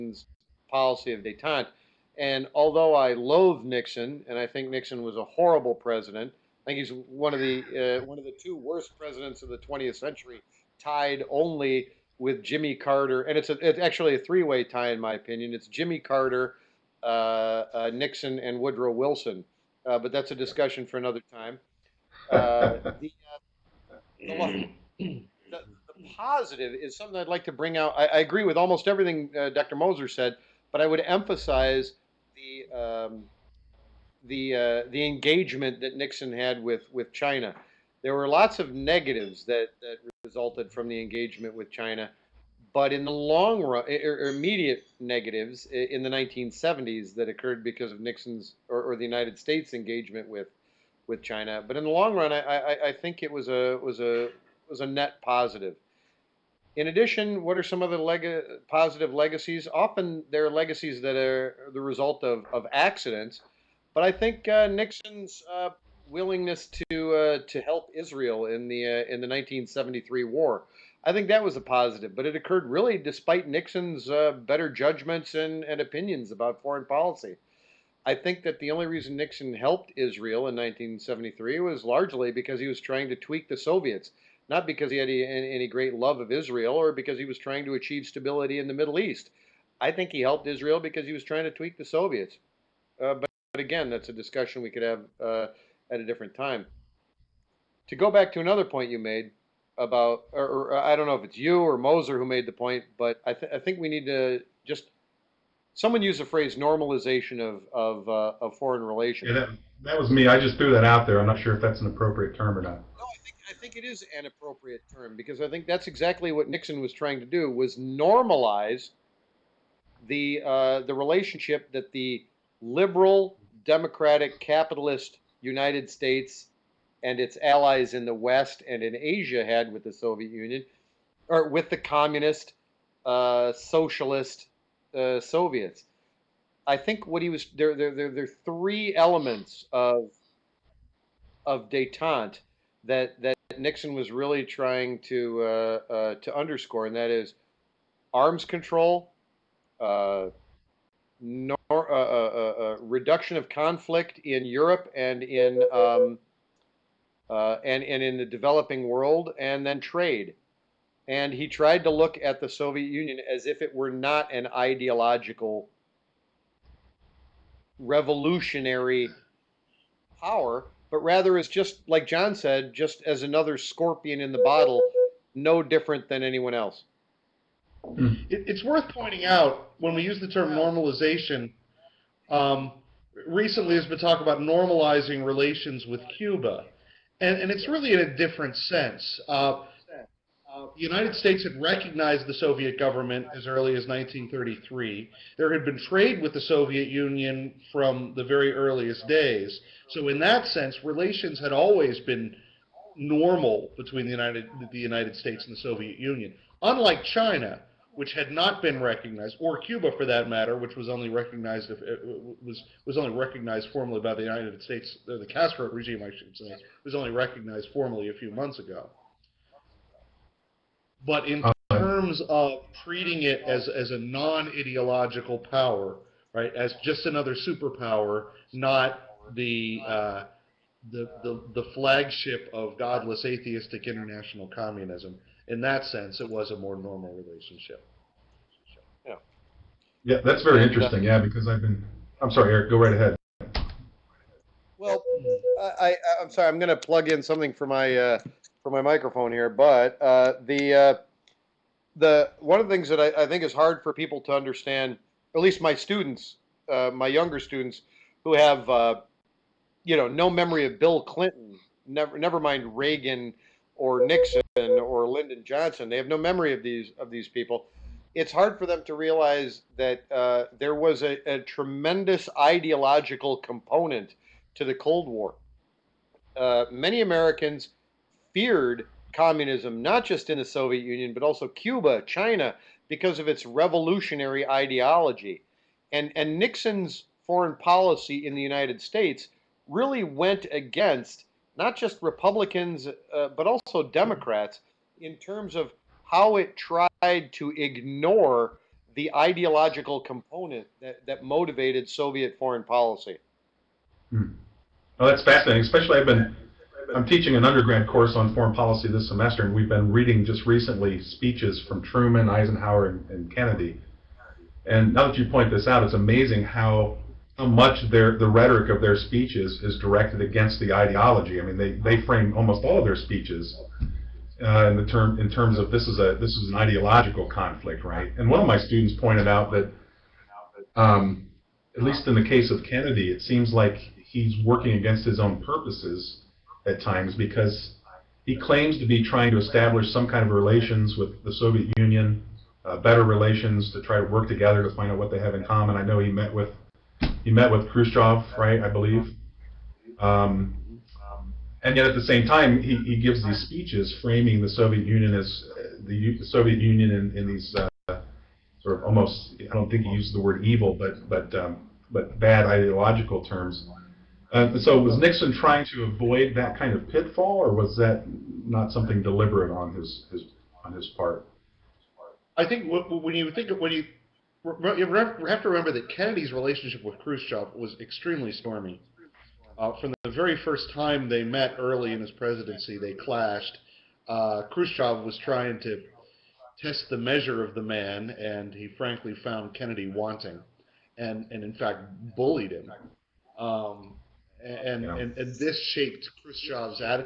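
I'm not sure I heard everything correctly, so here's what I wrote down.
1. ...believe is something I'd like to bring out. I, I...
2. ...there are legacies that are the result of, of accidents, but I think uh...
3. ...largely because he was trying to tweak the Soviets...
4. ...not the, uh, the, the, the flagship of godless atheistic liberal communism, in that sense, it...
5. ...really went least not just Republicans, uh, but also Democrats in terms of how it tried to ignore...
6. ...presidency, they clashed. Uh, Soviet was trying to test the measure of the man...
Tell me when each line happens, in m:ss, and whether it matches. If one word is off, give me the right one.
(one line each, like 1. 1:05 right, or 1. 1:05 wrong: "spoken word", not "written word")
1. 0:26 wrong: "positive", not "believe"
2. 1:00 right
3. 1:21 right
4. 3:48 wrong: "international", not "liberal"
5. 4:49 wrong: "against", not "least"
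6. 6:22 wrong: "Khrushchev", not "Soviet".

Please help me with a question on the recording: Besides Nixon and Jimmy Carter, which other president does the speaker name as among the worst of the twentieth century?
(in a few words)
Woodrow Wilson.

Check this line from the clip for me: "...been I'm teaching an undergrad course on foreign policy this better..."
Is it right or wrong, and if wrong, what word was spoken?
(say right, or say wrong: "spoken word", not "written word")
wrong: "semester", not "better".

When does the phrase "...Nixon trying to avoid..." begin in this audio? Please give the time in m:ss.
6:04.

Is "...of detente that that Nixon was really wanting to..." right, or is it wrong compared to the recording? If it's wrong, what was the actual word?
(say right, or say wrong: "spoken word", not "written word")
wrong: "trying", not "wanting".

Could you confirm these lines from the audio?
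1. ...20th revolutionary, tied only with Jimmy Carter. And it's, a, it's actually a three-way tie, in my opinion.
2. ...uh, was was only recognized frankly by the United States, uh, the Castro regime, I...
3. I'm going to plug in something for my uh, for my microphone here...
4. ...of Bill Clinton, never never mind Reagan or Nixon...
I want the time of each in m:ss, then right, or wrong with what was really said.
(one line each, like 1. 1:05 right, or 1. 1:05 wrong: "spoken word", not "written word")
1. 0:09 wrong: "century", not "revolutionary"
2. 3:31 wrong: "formally", not "frankly"
3. 4:06 right
4. 4:20 right.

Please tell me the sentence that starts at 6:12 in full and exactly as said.
I think when you think of when you you have to remember that Kennedy's relationship with Khrushchev was extremely stormy.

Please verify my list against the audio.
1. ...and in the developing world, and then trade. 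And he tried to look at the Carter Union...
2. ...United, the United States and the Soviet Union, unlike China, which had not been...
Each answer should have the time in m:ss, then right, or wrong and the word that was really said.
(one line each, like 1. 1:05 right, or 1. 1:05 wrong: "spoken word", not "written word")
1. 2:37 wrong: "Soviet", not "Carter"
2. 3:24 right.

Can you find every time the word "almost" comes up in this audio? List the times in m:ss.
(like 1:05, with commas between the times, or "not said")
0:28, 5:22, 5:58.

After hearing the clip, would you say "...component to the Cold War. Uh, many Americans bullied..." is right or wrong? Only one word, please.
wrong.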